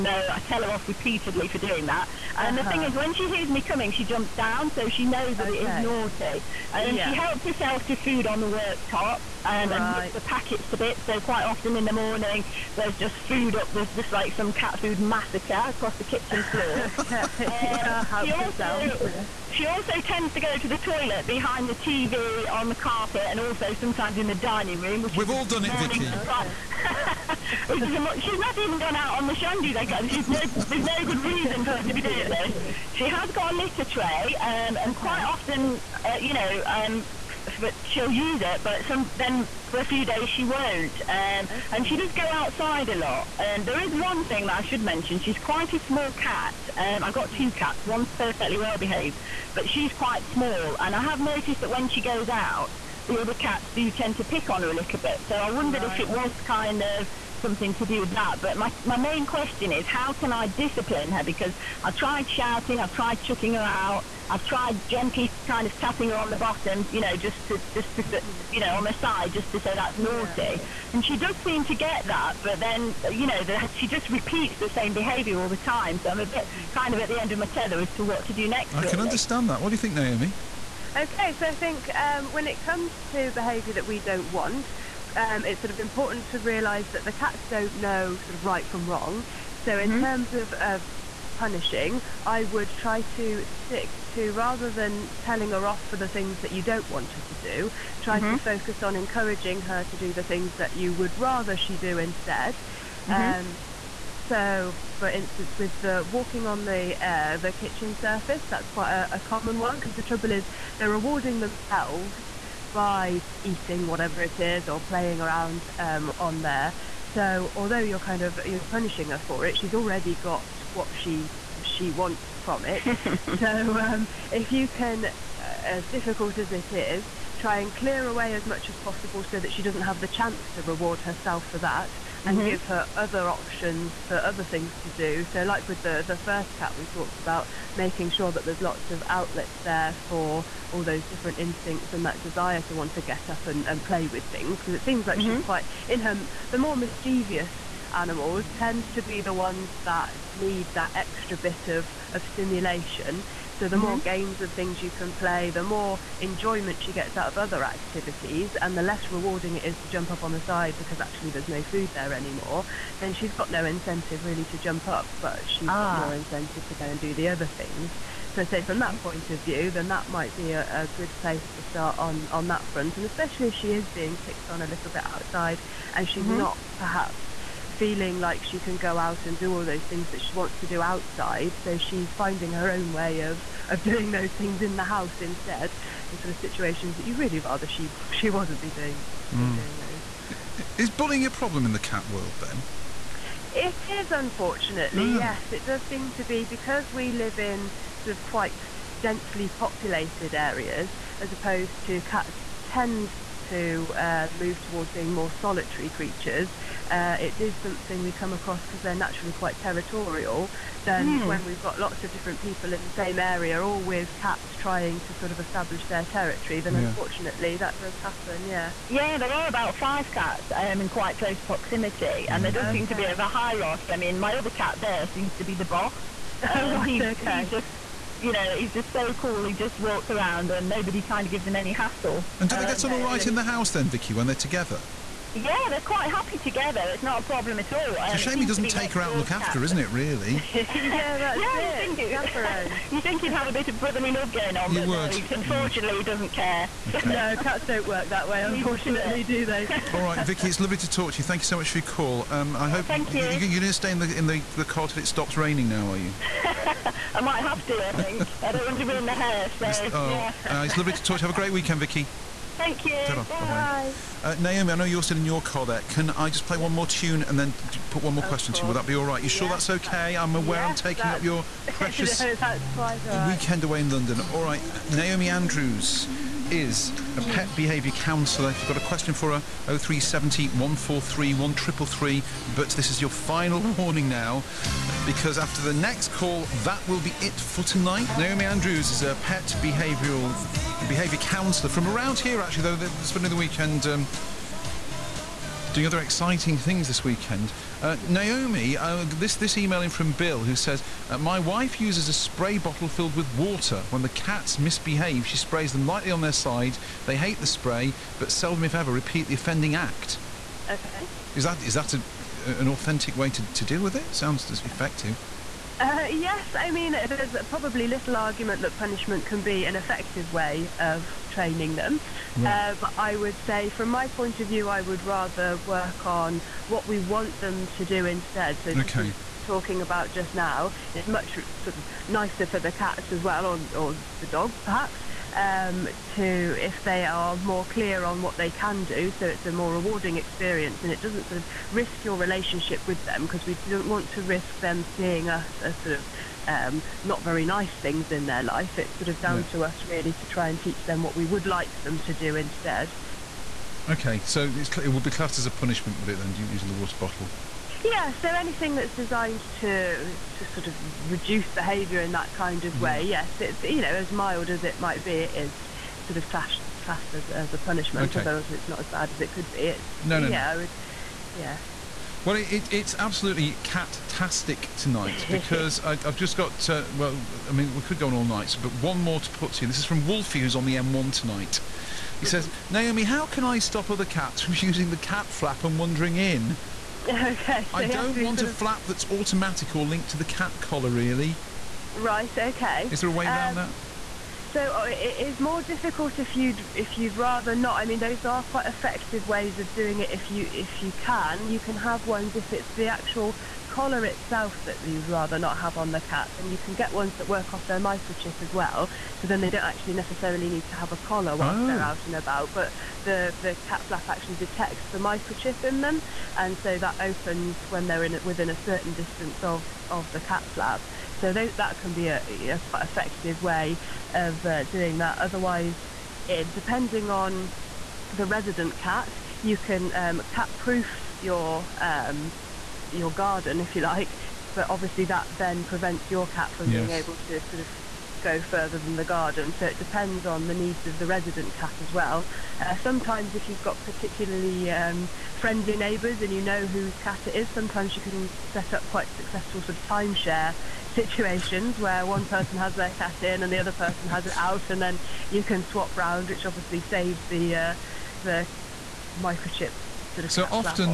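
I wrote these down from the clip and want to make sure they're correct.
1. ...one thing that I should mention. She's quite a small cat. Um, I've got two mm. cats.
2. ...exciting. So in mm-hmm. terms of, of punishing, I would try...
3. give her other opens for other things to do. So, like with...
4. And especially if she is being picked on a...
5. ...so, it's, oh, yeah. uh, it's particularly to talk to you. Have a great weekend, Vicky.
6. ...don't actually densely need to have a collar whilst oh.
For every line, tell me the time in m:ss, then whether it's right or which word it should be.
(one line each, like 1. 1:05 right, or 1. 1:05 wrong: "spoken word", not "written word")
1. 0:44 right
2. 1:28 wrong: "wrong", not "exciting"
3. 2:12 wrong: "options", not "opens"
4. 2:52 right
5. 4:19 wrong: "lovely", not "particularly"
6. 6:49 wrong: "necessarily", not "densely".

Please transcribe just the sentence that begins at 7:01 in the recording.
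So they, that can be a, a quite effective way of doing that.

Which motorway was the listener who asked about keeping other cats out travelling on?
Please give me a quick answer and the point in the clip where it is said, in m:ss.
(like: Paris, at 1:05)
M1, at 6:20.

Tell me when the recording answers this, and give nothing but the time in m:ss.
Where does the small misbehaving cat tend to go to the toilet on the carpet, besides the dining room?
0:21.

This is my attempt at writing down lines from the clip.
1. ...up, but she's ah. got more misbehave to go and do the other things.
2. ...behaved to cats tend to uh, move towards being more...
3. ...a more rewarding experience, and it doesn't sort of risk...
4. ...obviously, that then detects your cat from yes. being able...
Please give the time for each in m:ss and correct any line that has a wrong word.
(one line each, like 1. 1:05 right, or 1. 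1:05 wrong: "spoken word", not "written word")
1. 2:44 wrong: "incentive", not "misbehave"
2. 3:21 wrong: "opposed", not "behaved"
3. 5:39 right
4. 7:14 wrong: "prevents", not "detects".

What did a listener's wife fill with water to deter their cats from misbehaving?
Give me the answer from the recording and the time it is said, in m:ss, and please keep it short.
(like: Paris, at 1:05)
A spray bottle, at 5:02.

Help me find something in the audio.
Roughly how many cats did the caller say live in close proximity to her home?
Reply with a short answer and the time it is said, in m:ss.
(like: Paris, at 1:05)
5, at 3:39.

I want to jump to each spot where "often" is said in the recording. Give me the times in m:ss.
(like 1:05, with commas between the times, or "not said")
0:11, 0:35.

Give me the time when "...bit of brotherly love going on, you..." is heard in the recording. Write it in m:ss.
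4:03.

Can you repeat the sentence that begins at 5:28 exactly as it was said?
So okay talking about just now.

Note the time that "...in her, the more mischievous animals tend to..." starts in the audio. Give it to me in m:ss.
2:25.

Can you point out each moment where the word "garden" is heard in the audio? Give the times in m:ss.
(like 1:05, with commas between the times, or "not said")
7:13, 7:19.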